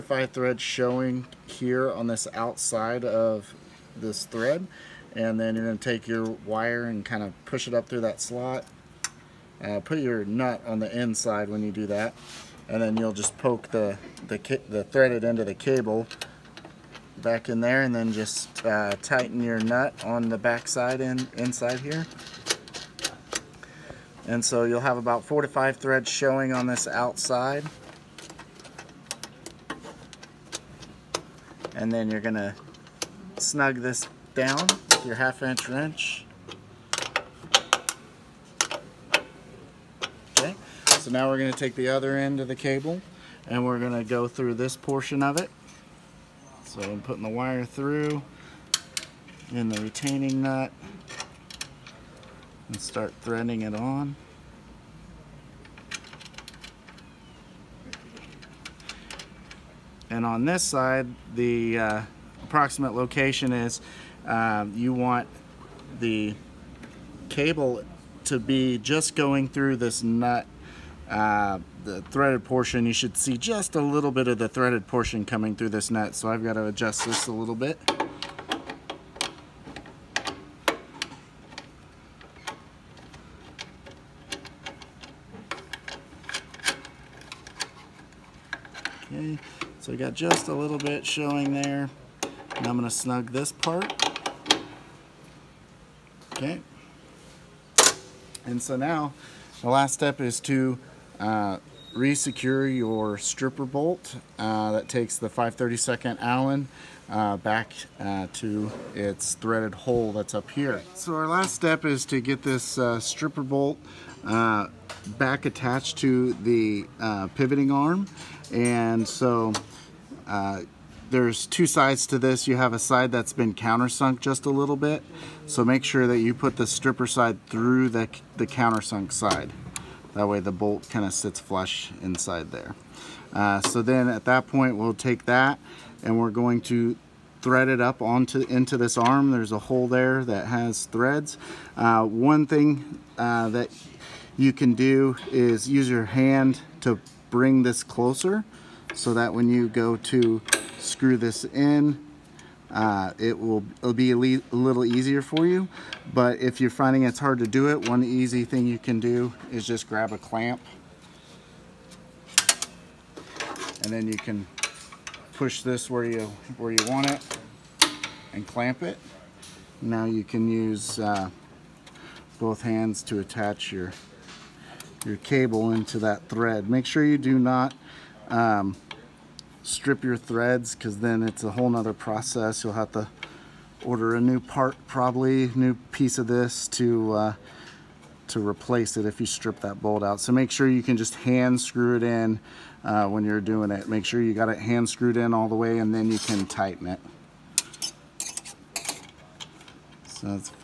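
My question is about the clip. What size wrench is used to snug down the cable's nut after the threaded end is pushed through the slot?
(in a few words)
half inch.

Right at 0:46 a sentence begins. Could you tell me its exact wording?
So I'm putting the wire through in the retaining nut and start threading it on.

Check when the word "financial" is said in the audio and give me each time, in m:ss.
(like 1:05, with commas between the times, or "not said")
not said.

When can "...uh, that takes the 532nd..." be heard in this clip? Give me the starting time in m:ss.
1:44.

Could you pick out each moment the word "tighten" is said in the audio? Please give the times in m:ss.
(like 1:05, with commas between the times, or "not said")
0:19, 3:16.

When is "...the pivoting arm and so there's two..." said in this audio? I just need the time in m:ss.
1:56.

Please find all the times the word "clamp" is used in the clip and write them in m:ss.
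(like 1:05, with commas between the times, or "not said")
2:40, 2:48.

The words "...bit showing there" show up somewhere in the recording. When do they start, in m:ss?
1:30.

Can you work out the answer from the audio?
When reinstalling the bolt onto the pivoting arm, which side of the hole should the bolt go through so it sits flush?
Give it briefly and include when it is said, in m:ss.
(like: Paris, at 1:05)
countersunk side, at 2:08.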